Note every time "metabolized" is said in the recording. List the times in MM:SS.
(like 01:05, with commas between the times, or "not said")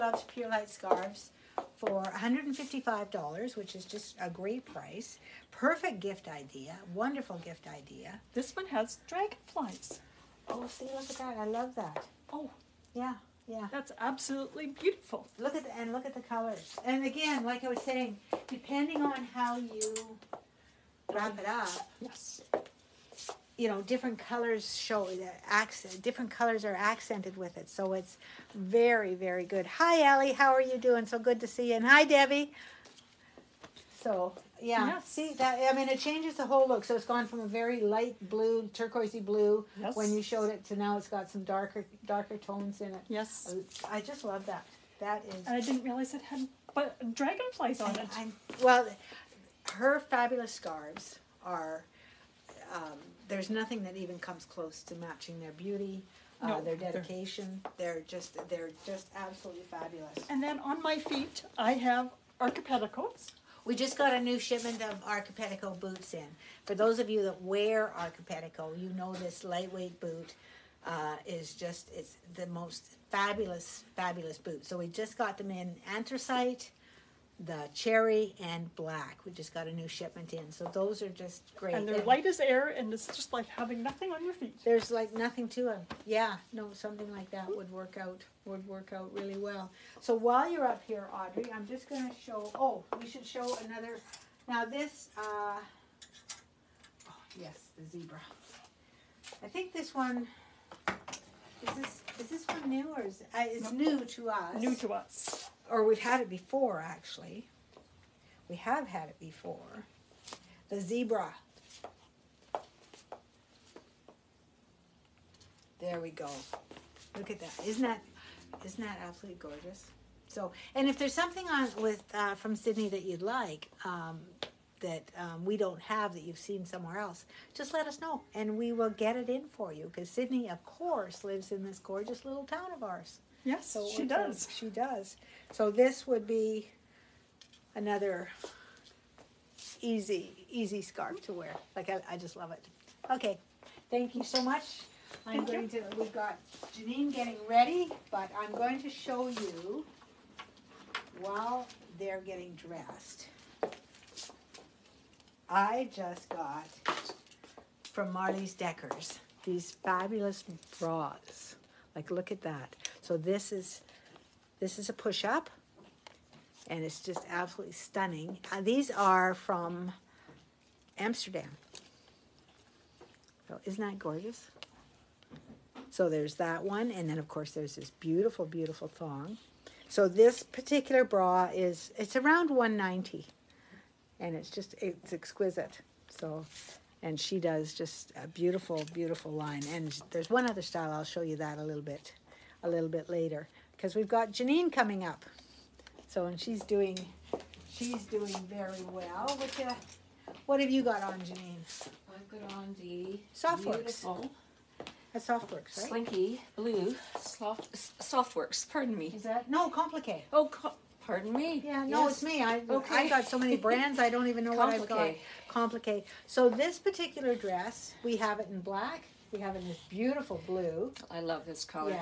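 not said.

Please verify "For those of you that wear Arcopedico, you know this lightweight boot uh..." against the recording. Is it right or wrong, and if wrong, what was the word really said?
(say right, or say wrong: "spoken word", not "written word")
right.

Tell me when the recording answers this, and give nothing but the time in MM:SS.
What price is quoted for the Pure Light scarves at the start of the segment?
00:02.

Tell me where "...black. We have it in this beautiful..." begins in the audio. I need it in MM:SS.
03:38.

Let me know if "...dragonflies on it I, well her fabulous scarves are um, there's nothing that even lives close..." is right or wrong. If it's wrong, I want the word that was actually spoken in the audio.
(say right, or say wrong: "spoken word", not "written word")
wrong: "comes", not "lives".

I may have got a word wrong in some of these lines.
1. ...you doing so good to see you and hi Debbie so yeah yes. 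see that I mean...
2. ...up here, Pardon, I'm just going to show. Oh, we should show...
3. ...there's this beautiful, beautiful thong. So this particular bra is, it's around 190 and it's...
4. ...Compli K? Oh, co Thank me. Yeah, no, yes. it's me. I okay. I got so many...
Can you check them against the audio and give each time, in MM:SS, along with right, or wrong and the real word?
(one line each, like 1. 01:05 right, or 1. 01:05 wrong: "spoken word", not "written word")
1. 00:30 right
2. 01:30 wrong: "Audrey", not "Pardon"
3. 02:57 right
4. 03:29 wrong: "Pardon", not "Thank".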